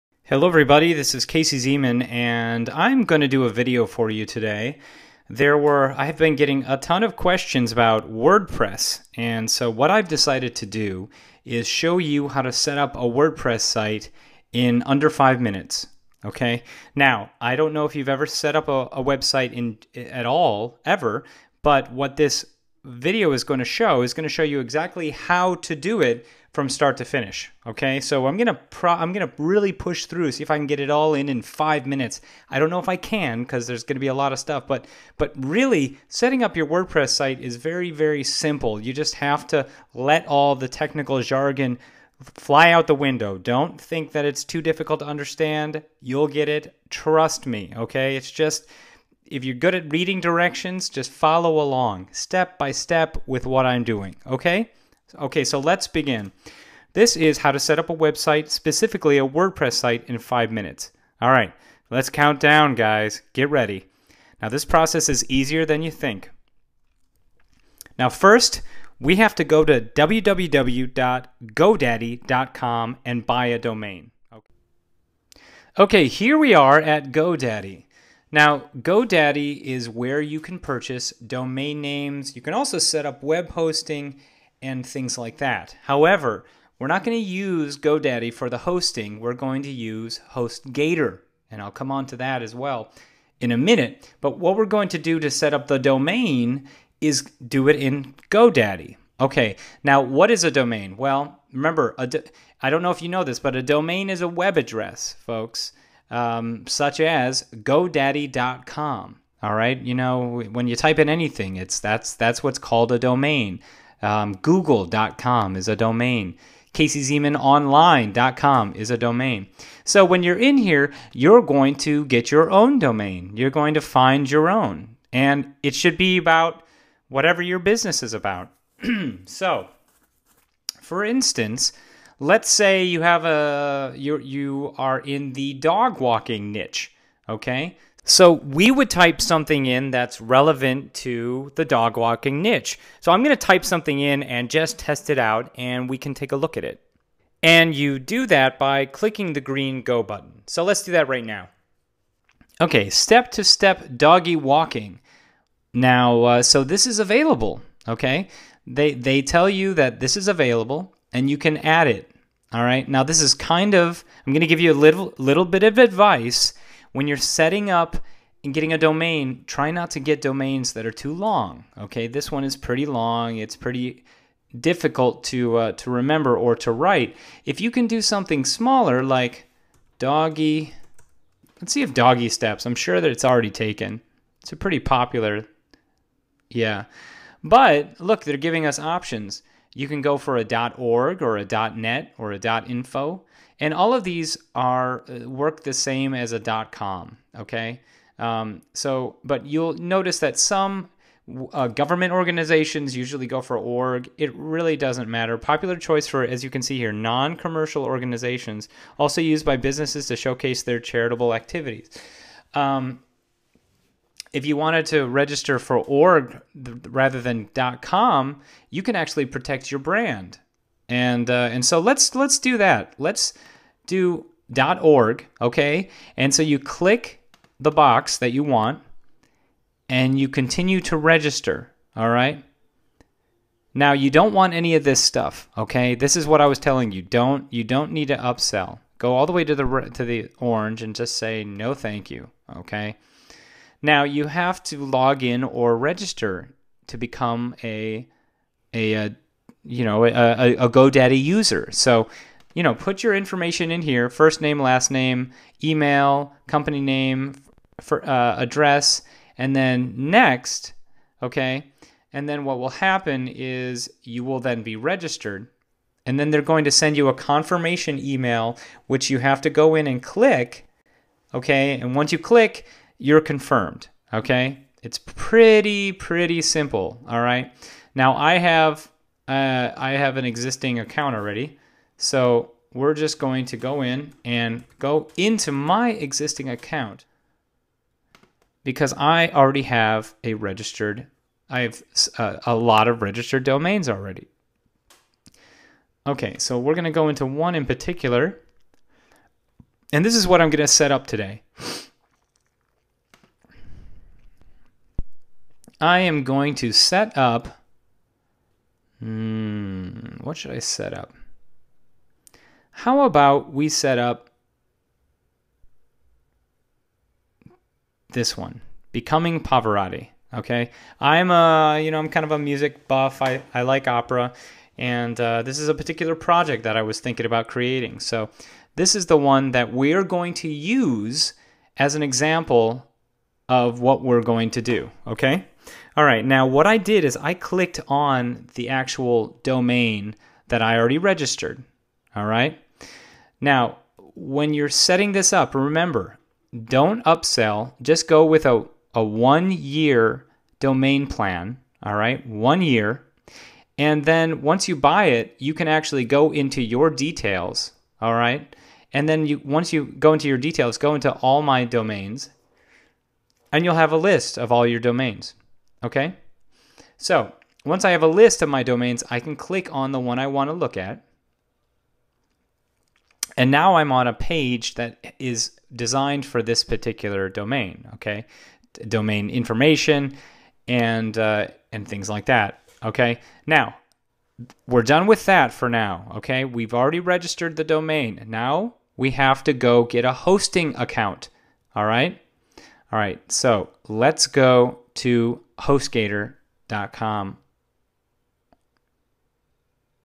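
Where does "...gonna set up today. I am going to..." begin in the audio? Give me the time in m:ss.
5:00.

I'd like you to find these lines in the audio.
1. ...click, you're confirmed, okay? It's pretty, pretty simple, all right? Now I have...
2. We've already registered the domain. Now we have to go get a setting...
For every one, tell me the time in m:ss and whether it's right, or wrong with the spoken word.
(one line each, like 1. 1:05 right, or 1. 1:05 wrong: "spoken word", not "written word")
1. 4:32 right
2. 6:26 wrong: "hosting", not "setting".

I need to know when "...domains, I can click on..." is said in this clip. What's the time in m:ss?
6:08.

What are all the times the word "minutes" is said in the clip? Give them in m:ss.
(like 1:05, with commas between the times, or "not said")
0:15, 0:31, 1:00, 1:33.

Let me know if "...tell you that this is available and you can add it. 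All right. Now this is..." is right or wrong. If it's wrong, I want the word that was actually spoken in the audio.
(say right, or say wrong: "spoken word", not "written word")
right.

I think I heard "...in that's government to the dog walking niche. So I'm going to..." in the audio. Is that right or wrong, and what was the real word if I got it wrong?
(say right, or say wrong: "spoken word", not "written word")
wrong: "relevant", not "government".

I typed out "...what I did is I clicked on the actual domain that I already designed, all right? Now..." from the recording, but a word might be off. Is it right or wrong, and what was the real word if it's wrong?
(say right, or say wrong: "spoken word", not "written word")
wrong: "registered", not "designed".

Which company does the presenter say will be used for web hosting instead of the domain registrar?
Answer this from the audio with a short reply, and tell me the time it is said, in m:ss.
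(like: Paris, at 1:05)
HostGator, at 1:29.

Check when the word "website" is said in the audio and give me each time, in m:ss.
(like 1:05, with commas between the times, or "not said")
0:19, 0:57.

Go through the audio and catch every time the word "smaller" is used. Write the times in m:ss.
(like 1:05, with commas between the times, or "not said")
2:58.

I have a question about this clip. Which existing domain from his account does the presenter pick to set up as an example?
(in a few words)
Becoming Pavarotti.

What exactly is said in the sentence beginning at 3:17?
Okay, um, so but you'll notice that some uh, government organizations usually go for org.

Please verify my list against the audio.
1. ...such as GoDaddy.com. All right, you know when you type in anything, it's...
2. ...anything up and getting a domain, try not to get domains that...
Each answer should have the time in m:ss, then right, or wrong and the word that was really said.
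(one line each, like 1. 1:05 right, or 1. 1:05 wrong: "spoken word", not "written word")
1. 1:46 right
2. 2:47 wrong: "setting", not "anything".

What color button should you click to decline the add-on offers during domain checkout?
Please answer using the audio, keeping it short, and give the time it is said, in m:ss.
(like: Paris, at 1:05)
orange, at 3:58.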